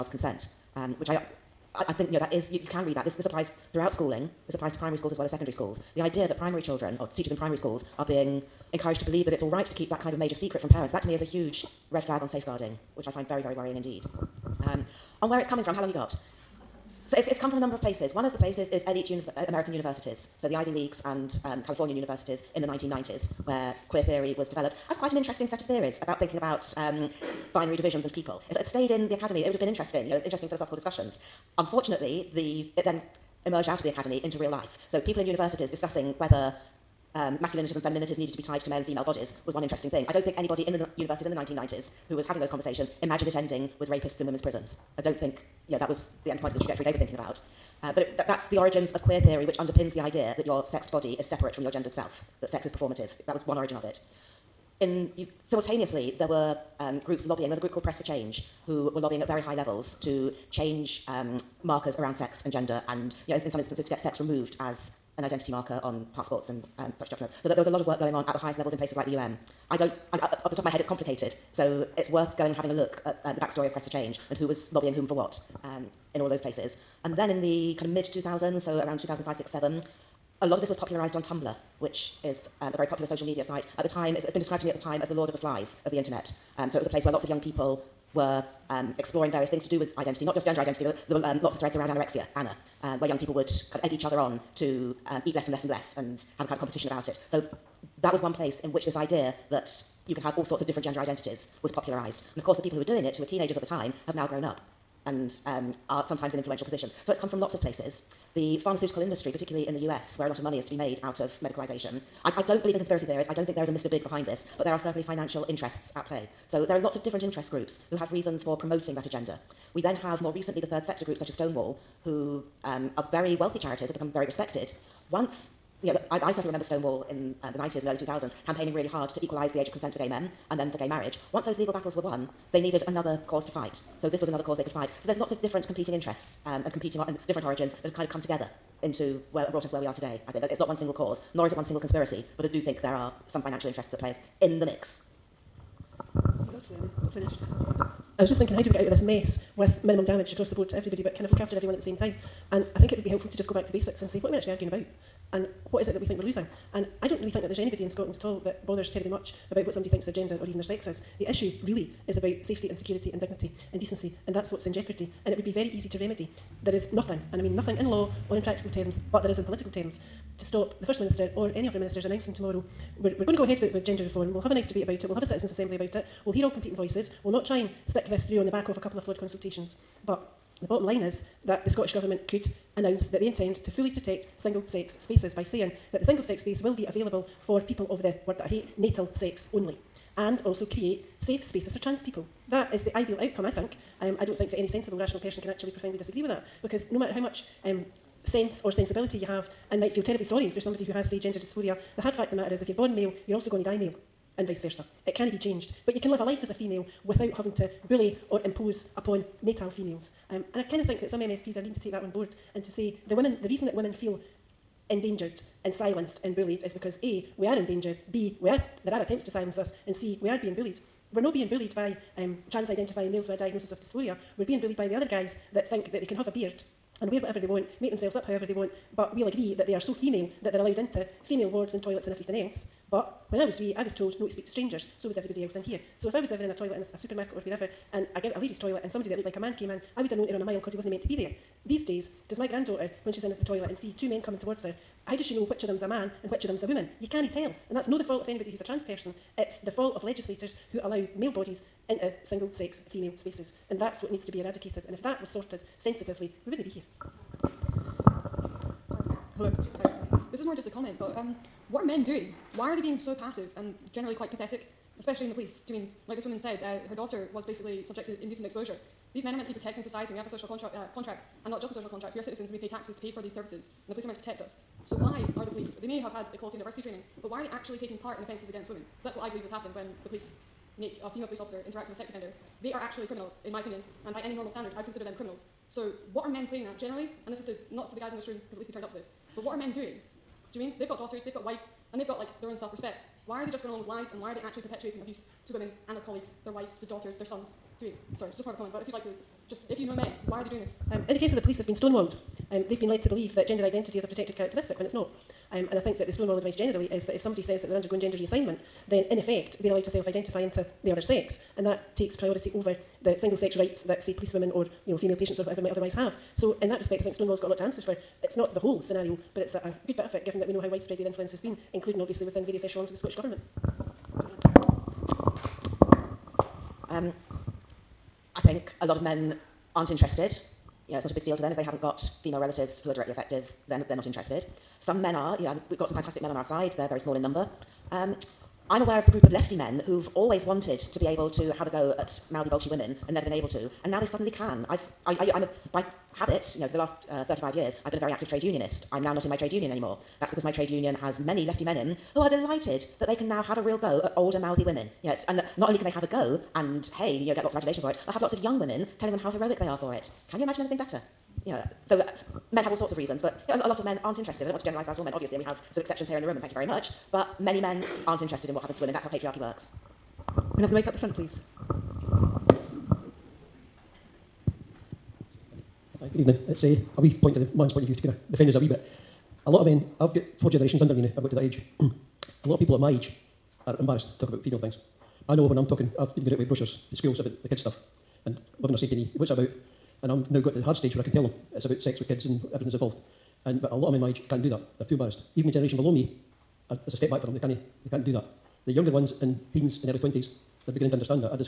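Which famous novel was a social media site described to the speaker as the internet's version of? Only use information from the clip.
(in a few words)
Lord of the Flies.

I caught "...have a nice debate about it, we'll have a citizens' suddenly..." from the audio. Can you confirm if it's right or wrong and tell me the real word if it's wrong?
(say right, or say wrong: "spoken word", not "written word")
wrong: "assembly", not "suddenly".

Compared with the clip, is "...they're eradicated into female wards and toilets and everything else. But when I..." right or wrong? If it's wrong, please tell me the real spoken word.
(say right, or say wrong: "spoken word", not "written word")
wrong: "allowed", not "eradicated".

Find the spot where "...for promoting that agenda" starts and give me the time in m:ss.
1:58.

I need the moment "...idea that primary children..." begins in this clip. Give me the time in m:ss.
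0:06.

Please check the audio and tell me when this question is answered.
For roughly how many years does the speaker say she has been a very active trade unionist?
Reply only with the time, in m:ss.
5:47.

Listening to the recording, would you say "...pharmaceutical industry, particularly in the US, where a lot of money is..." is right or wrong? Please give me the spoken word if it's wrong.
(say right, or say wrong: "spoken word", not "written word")
right.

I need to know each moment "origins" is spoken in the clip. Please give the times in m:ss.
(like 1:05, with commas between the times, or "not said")
0:48, 0:53, 2:17.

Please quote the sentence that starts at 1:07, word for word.
So that there was a lot of work going on at the highest levels in places like the UN.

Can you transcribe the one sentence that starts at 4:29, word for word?
These men are meant to be protecting society, we have a social contra- uh, contract, and not just a social contract.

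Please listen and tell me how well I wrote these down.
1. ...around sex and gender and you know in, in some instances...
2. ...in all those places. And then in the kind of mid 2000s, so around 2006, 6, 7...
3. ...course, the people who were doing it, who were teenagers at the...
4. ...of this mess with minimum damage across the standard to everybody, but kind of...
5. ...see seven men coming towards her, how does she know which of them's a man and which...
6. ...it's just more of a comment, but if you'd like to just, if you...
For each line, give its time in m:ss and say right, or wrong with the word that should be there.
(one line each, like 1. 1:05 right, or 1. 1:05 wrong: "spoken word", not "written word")
1. 1:01 right
2. 1:16 wrong: "2005", not "2006"
3. 1:42 right
4. 2:28 wrong: "board", not "standard"
5. 4:03 wrong: "two", not "seven"
6. 4:58 right.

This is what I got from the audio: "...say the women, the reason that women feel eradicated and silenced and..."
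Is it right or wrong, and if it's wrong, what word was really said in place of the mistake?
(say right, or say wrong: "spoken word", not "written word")
wrong: "endangered", not "eradicated".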